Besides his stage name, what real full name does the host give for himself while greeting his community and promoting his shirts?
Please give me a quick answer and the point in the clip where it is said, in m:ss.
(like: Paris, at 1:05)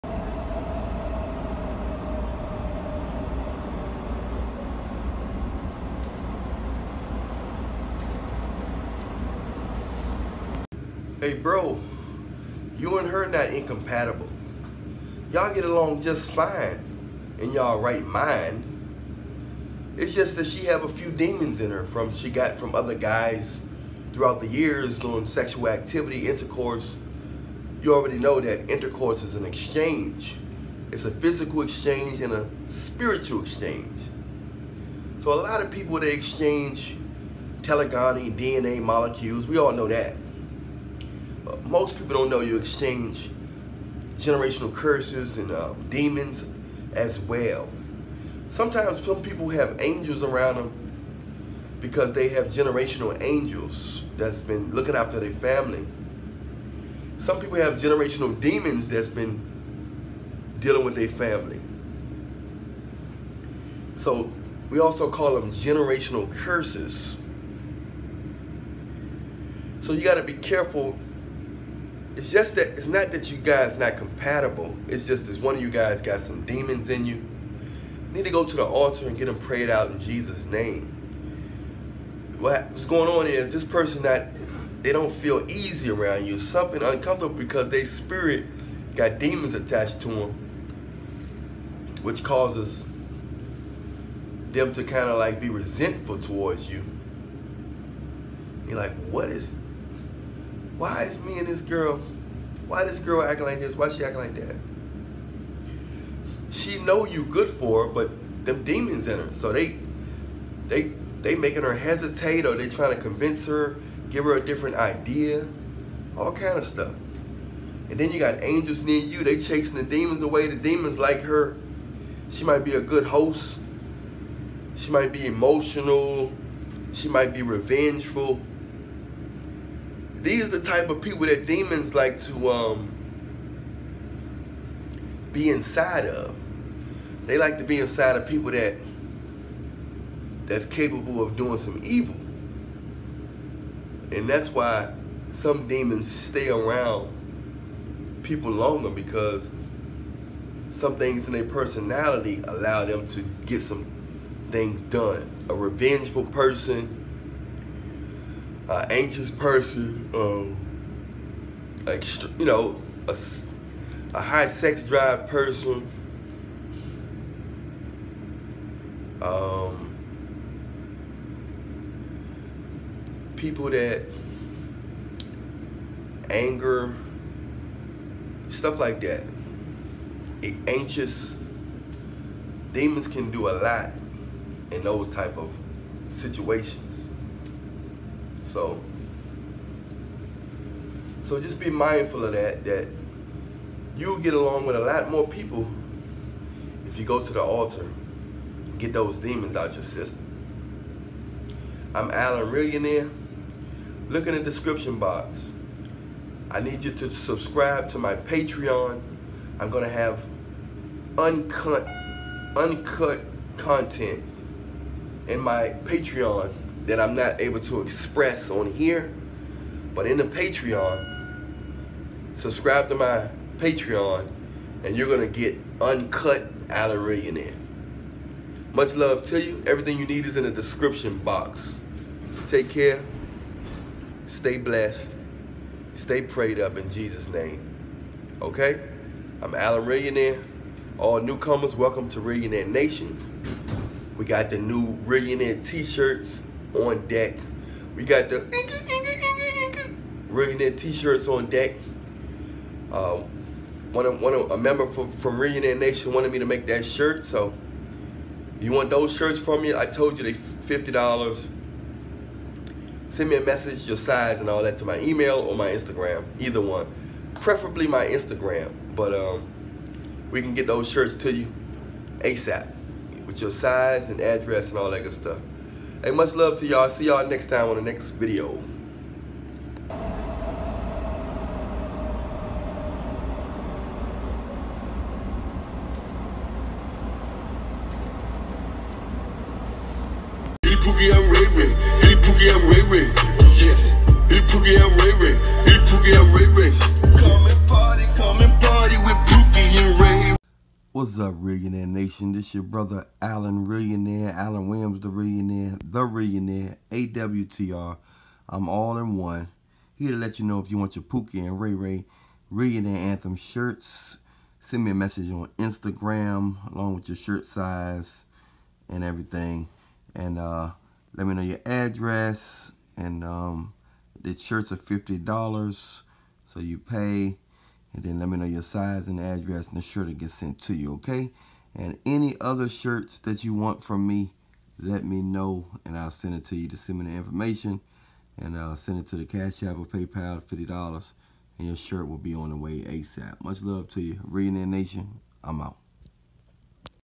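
Allan Williams, at 5:04.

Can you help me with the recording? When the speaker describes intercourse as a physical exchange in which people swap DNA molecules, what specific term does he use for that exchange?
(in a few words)
telegony.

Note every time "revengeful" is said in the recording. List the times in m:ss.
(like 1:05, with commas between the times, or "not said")
2:07, 2:35.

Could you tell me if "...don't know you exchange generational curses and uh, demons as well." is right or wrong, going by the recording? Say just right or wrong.
right.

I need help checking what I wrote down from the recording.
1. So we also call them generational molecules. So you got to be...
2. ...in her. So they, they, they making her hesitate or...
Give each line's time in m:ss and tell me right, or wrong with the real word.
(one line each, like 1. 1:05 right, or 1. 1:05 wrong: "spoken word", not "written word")
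1. 1:03 wrong: "curses", not "molecules"
2. 1:49 right.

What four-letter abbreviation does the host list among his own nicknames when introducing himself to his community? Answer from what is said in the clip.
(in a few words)
AWTR.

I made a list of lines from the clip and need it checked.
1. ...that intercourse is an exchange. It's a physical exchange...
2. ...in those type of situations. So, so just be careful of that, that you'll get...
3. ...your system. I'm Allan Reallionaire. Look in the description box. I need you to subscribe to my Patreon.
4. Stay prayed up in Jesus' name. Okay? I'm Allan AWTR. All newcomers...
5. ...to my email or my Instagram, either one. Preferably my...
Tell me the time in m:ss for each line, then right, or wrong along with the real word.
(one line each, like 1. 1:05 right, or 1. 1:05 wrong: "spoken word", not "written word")
1. 0:28 right
2. 3:04 wrong: "mindful", not "careful"
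3. 3:19 right
4. 3:55 wrong: "Reallionaire", not "AWTR"
5. 4:24 right.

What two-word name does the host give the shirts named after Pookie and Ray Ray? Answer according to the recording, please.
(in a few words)
Reallionaire Anthem.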